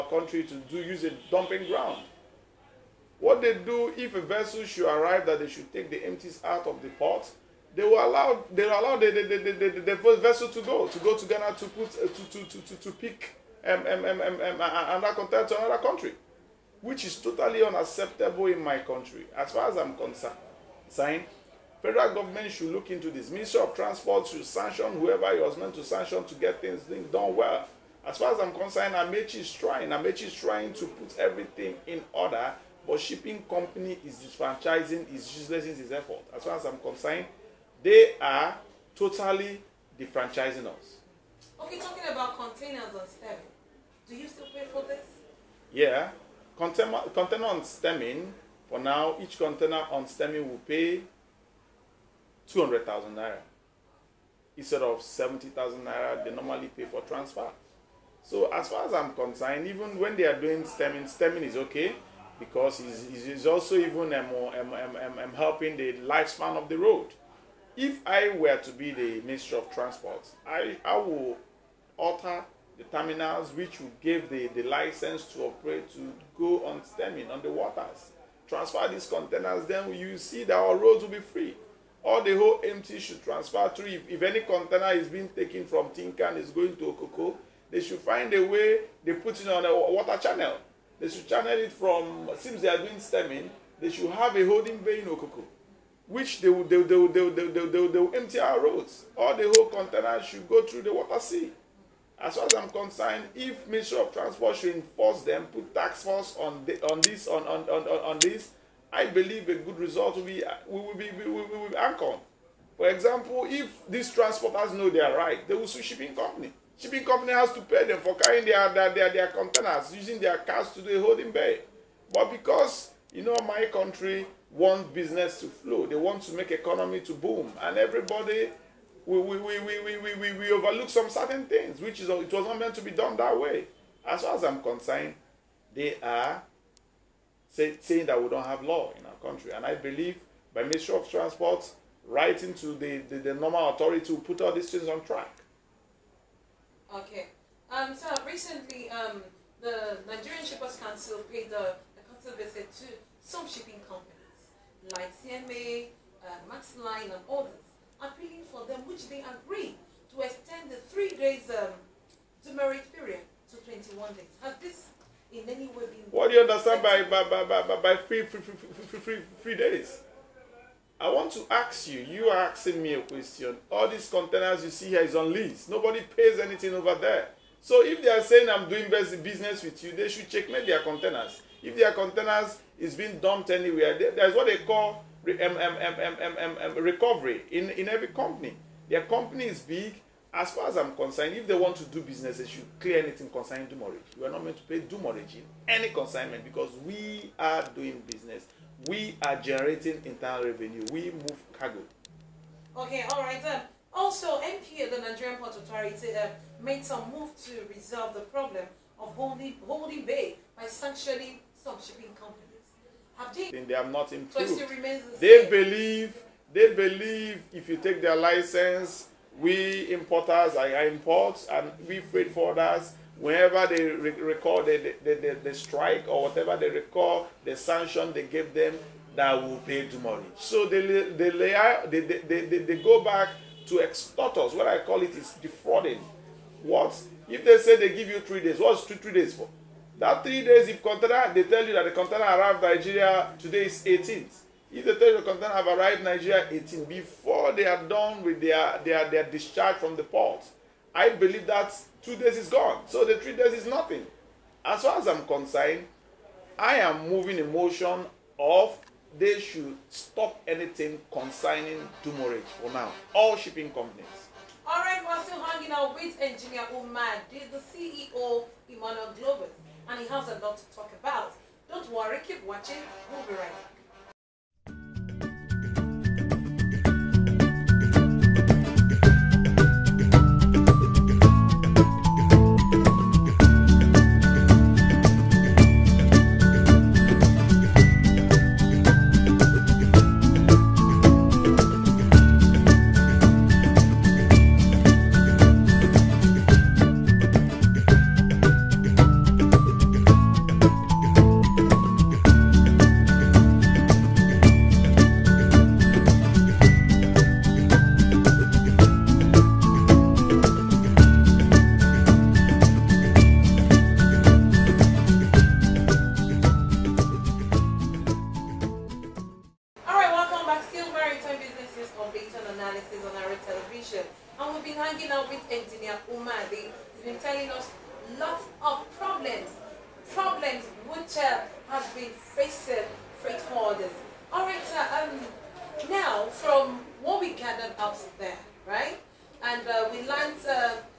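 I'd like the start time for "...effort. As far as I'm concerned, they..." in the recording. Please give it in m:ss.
0:35.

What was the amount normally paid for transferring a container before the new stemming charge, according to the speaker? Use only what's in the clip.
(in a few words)
70,000 naira.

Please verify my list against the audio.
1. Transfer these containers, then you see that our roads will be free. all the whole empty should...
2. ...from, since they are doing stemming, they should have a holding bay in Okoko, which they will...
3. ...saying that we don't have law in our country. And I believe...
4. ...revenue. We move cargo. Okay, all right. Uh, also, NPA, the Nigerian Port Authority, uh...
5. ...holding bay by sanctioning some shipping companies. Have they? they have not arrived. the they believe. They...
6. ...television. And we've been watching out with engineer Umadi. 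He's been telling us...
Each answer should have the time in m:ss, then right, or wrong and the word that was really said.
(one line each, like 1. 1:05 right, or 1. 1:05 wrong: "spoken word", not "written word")
1. 1:18 right
2. 1:31 right
3. 2:17 right
4. 3:20 right
5. 3:29 wrong: "improved", not "arrived"
6. 5:23 wrong: "hanging", not "watching".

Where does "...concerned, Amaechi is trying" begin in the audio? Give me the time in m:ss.
0:28.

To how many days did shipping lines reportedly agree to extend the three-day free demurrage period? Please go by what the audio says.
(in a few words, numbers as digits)
21 days.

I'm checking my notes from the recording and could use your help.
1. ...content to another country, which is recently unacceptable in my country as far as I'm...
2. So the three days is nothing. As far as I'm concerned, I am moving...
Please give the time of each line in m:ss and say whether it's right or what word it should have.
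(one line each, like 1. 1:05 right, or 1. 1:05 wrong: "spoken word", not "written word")
1. 0:15 wrong: "totally", not "recently"
2. 4:12 right.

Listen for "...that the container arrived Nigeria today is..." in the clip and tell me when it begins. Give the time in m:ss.
4:01.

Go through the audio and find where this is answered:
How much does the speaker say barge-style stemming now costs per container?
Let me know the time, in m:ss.
0:52.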